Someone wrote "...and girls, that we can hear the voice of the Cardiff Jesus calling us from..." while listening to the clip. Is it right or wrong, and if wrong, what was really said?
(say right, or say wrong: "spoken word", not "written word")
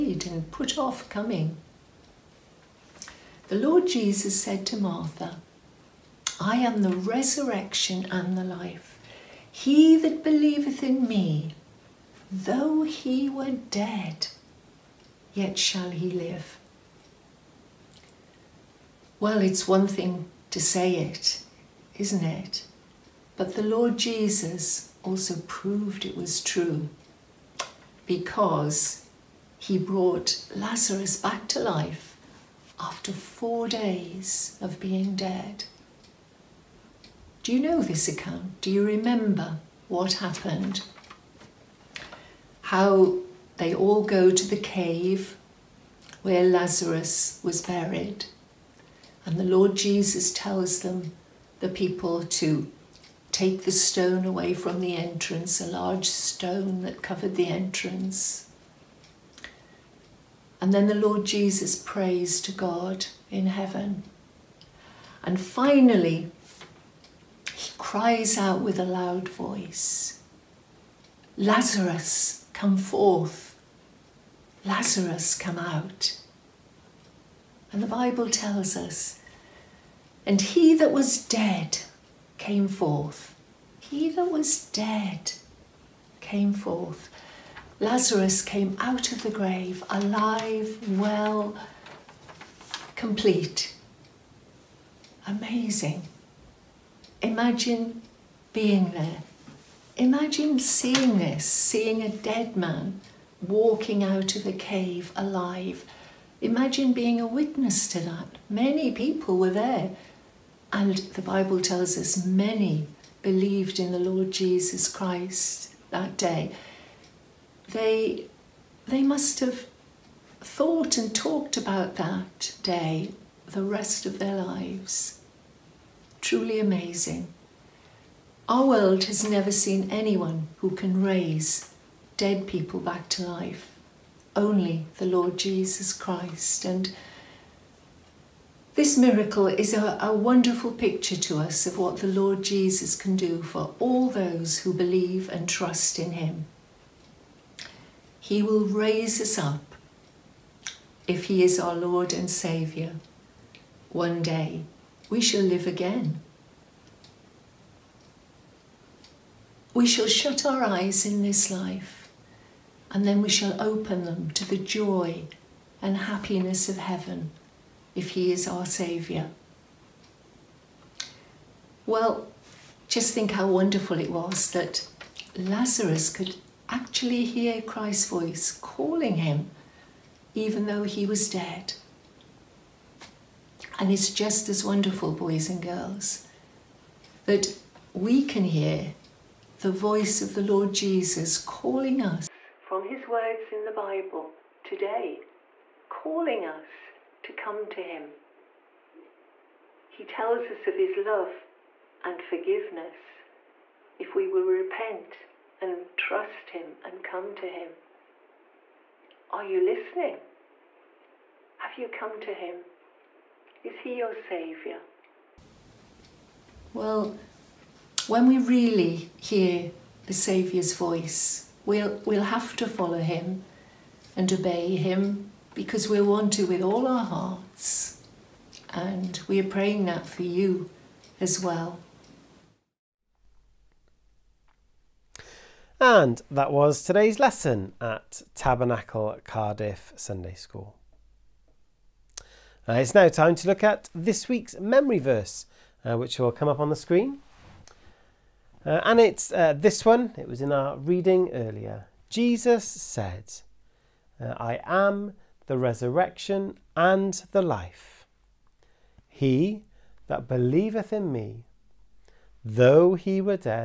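wrong: "Lord", not "Cardiff".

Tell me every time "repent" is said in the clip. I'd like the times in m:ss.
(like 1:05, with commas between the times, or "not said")
3:24.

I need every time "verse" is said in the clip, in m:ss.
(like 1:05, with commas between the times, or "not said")
4:04.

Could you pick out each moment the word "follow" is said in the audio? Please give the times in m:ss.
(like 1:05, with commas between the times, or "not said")
3:42.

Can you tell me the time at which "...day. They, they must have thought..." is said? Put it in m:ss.
1:56.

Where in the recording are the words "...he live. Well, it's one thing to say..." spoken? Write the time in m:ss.
0:15.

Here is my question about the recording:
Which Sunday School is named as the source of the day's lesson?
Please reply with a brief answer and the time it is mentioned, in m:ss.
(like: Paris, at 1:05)
Tabernacle Cardiff Sunday School, at 3:58.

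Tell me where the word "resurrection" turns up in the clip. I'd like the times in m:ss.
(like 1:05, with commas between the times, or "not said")
0:07, 4:15.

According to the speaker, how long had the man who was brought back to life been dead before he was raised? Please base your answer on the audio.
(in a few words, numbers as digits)
4 days.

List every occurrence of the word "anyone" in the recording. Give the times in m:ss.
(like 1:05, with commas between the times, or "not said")
2:09.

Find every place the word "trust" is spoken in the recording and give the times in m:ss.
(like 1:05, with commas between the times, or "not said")
2:25, 3:25.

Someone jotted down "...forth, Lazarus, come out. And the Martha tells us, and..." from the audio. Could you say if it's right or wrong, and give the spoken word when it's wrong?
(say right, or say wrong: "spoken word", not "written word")
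wrong: "Bible", not "Martha".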